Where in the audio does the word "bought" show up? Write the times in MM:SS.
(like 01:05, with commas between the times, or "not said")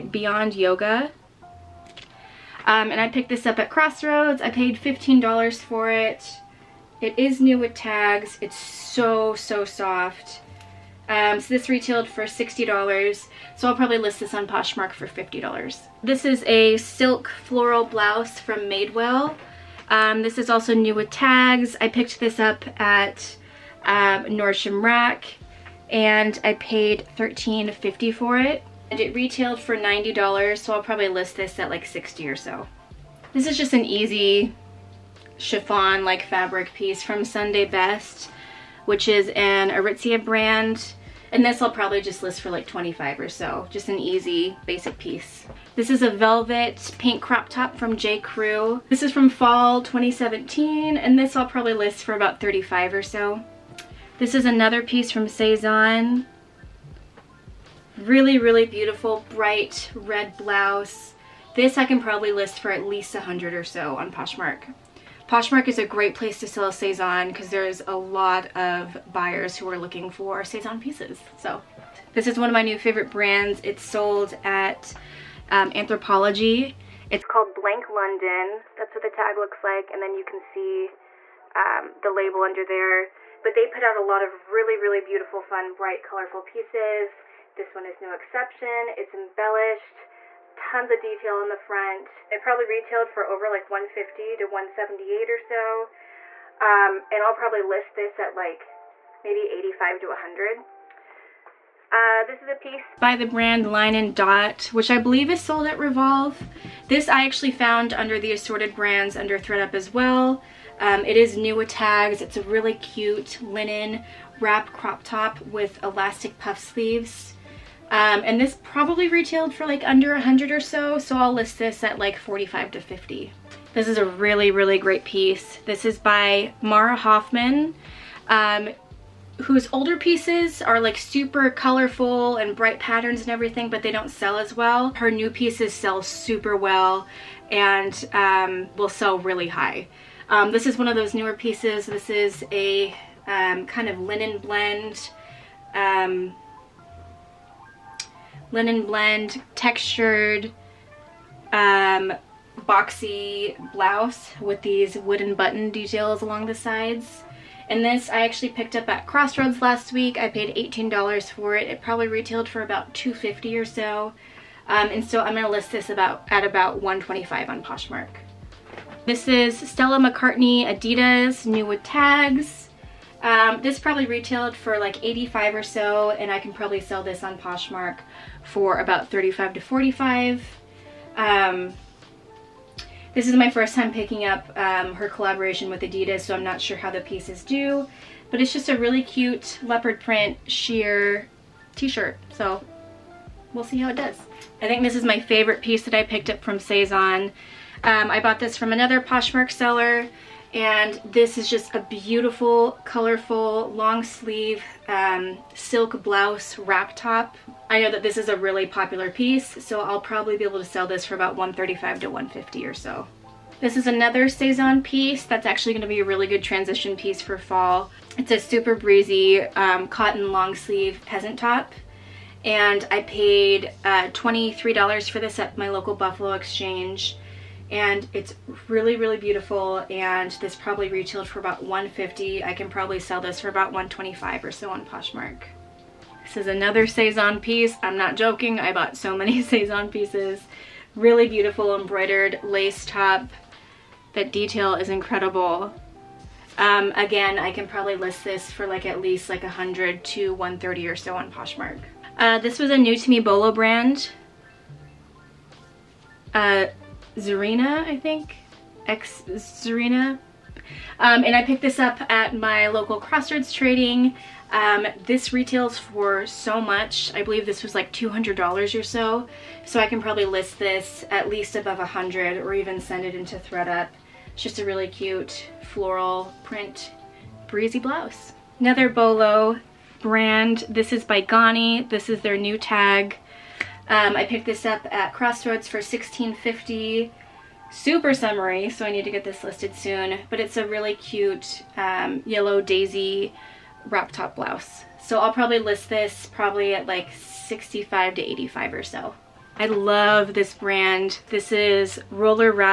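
03:18, 03:58.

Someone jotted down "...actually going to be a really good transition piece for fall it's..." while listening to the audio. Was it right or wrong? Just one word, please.
right.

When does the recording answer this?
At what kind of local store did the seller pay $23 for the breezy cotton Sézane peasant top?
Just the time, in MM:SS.
03:45.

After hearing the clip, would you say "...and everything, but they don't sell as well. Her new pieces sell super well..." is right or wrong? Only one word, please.
right.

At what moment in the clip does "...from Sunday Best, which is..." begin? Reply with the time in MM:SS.
00:37.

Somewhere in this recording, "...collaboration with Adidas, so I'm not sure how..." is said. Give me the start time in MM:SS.
03:05.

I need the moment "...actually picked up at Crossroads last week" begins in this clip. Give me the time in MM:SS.
02:38.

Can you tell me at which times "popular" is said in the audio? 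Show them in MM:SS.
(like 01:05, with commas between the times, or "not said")
03:28.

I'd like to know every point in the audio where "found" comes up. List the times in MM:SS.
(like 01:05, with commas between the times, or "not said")
01:47.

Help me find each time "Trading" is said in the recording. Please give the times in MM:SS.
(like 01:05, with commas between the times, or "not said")
04:23.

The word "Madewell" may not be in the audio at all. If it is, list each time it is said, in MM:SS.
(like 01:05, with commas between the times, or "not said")
00:18.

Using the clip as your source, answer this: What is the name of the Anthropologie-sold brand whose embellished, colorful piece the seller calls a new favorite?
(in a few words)
Blank London.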